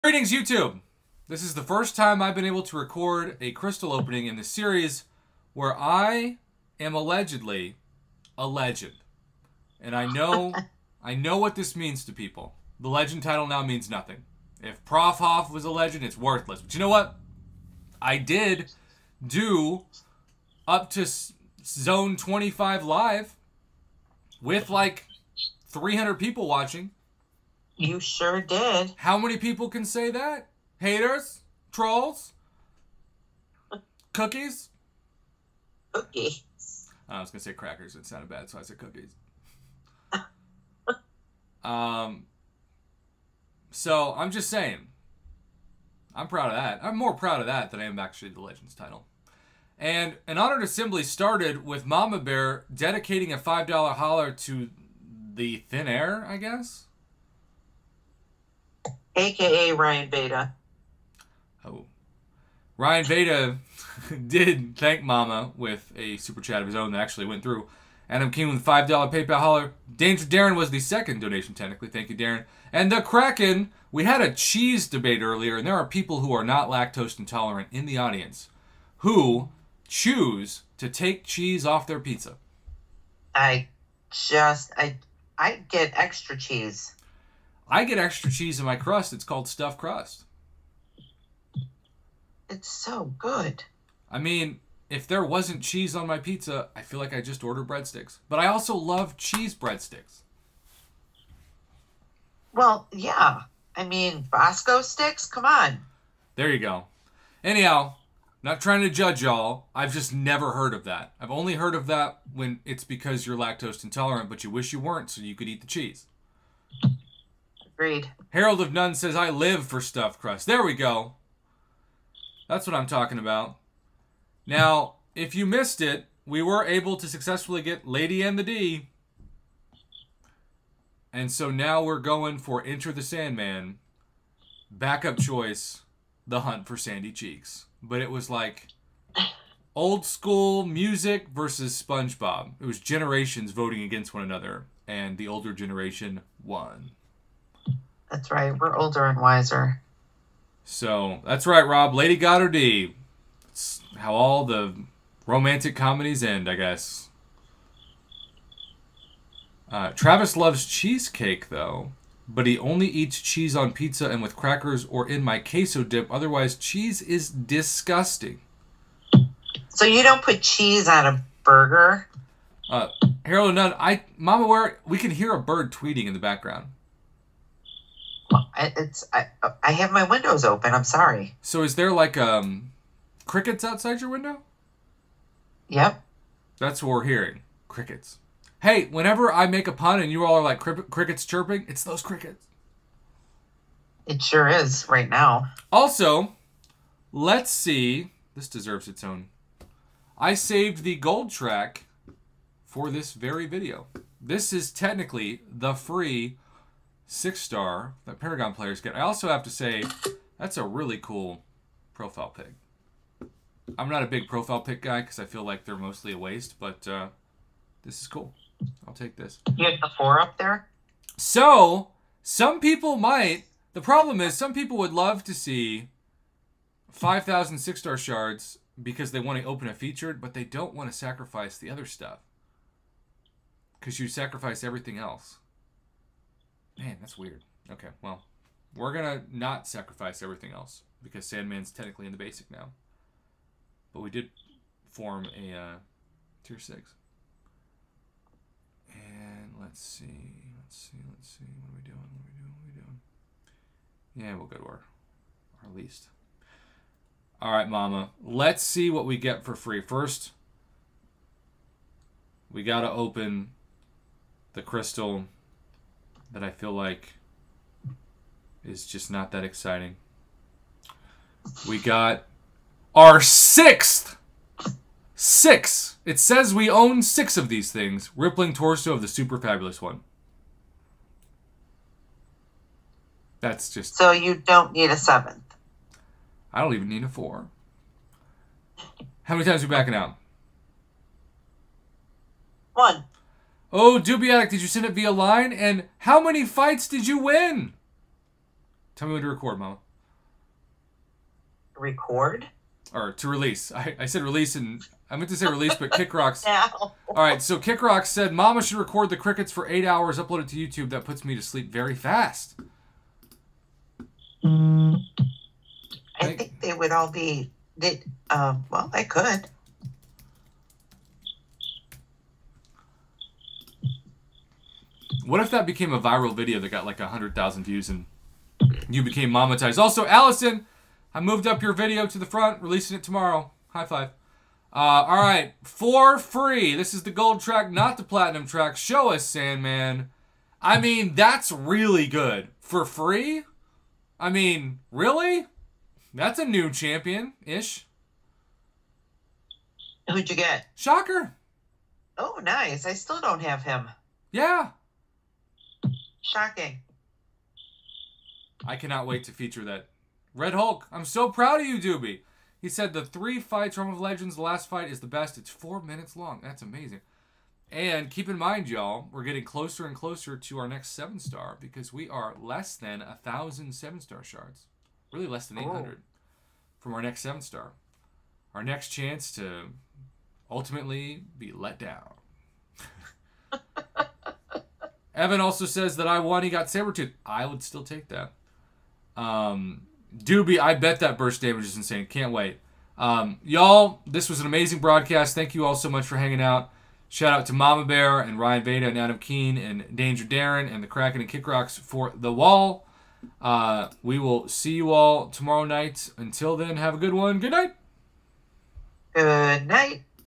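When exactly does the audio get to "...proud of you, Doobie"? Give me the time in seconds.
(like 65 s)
361 s.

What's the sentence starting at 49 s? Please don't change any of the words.
And an honored assembly started with Mama Bear dedicating a five dollar holler to the thin air, I guess aka Ryan Veda.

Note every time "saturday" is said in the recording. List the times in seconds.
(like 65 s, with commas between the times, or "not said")
not said.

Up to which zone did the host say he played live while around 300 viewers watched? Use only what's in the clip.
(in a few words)
25.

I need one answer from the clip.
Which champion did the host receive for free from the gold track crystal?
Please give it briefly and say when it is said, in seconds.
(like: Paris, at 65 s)
Shocker, at 350 s.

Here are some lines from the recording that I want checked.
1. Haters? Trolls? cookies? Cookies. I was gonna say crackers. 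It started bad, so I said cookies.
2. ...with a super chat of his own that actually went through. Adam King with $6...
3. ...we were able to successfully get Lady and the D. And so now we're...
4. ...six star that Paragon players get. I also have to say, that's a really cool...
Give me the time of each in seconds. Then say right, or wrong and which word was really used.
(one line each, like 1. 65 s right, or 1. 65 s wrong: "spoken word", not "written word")
1. 30 s wrong: "sounded", not "started"
2. 65 s wrong: "5", not "6"
3. 126 s right
4. 207 s right.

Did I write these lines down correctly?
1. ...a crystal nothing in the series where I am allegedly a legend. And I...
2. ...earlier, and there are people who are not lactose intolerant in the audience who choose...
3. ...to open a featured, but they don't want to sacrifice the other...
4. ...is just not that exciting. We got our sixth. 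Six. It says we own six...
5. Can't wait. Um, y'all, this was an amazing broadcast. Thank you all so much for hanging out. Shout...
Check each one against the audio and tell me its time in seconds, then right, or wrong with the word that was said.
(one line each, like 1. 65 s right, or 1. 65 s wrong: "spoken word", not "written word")
1. 3 s wrong: "opening", not "nothing"
2. 75 s right
3. 229 s right
4. 268 s right
5. 392 s right.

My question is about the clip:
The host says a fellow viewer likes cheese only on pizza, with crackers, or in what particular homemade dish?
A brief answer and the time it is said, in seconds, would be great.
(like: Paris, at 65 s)
Queso dip, at 165 s.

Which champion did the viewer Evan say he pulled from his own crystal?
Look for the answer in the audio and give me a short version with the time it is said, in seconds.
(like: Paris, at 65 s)
Sabretooth, at 386 s.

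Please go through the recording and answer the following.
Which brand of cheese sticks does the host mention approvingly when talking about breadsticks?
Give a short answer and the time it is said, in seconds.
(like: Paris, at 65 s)
Bosco sticks, at 104 s.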